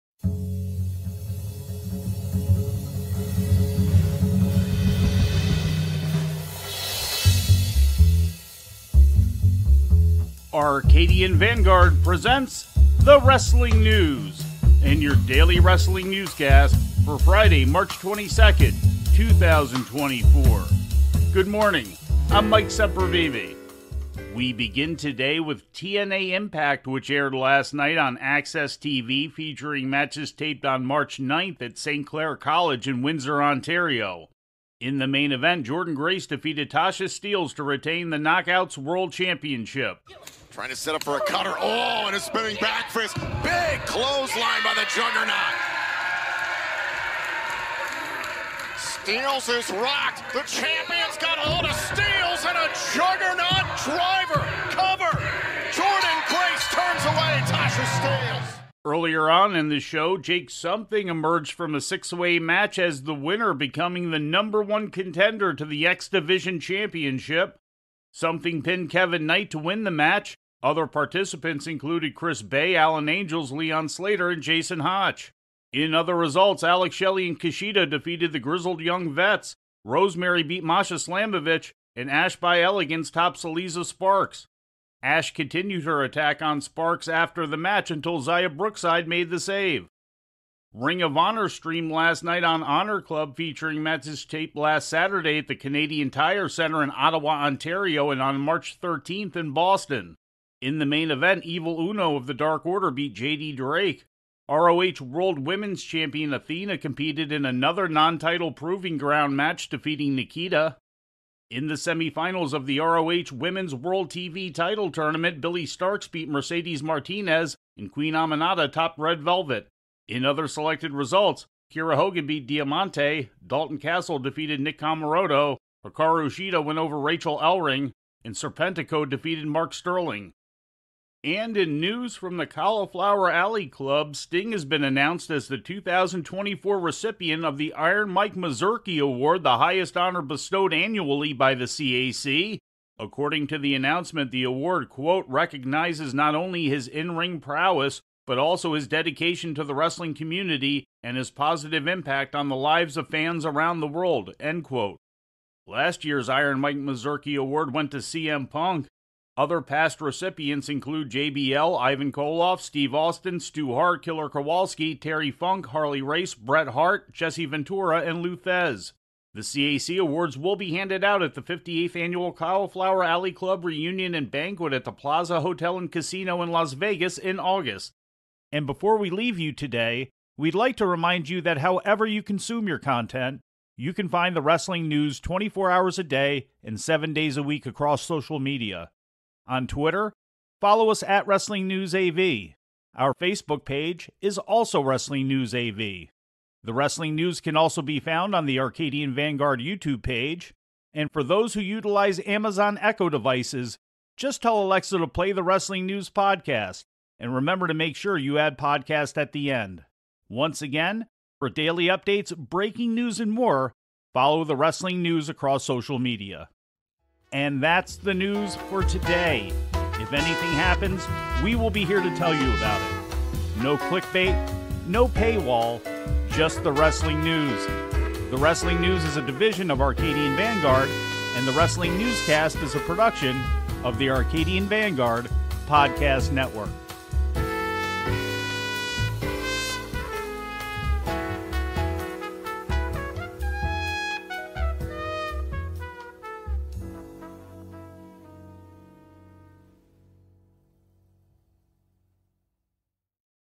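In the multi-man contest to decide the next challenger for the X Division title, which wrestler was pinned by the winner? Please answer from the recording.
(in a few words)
Kevin Knight.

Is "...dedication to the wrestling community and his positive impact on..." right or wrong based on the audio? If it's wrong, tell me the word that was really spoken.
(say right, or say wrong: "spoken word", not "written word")
right.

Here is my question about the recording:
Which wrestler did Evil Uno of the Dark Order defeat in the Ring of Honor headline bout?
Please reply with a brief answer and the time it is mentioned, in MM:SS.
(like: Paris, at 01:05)
JD Drake, at 01:43.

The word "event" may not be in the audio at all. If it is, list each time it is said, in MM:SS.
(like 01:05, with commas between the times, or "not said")
00:35, 01:41.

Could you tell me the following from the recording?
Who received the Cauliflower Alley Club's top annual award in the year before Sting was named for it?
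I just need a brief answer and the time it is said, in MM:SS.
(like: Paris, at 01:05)
CM Punk, at 02:37.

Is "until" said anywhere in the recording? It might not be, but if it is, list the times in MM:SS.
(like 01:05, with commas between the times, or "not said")
01:27.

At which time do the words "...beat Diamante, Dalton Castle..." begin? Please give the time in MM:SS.
02:02.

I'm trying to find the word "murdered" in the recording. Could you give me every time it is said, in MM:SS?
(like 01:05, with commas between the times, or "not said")
not said.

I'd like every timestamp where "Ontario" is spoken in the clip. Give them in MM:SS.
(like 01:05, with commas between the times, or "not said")
00:33, 01:37.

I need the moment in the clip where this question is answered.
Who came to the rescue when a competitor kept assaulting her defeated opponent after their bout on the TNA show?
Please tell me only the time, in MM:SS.
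01:28.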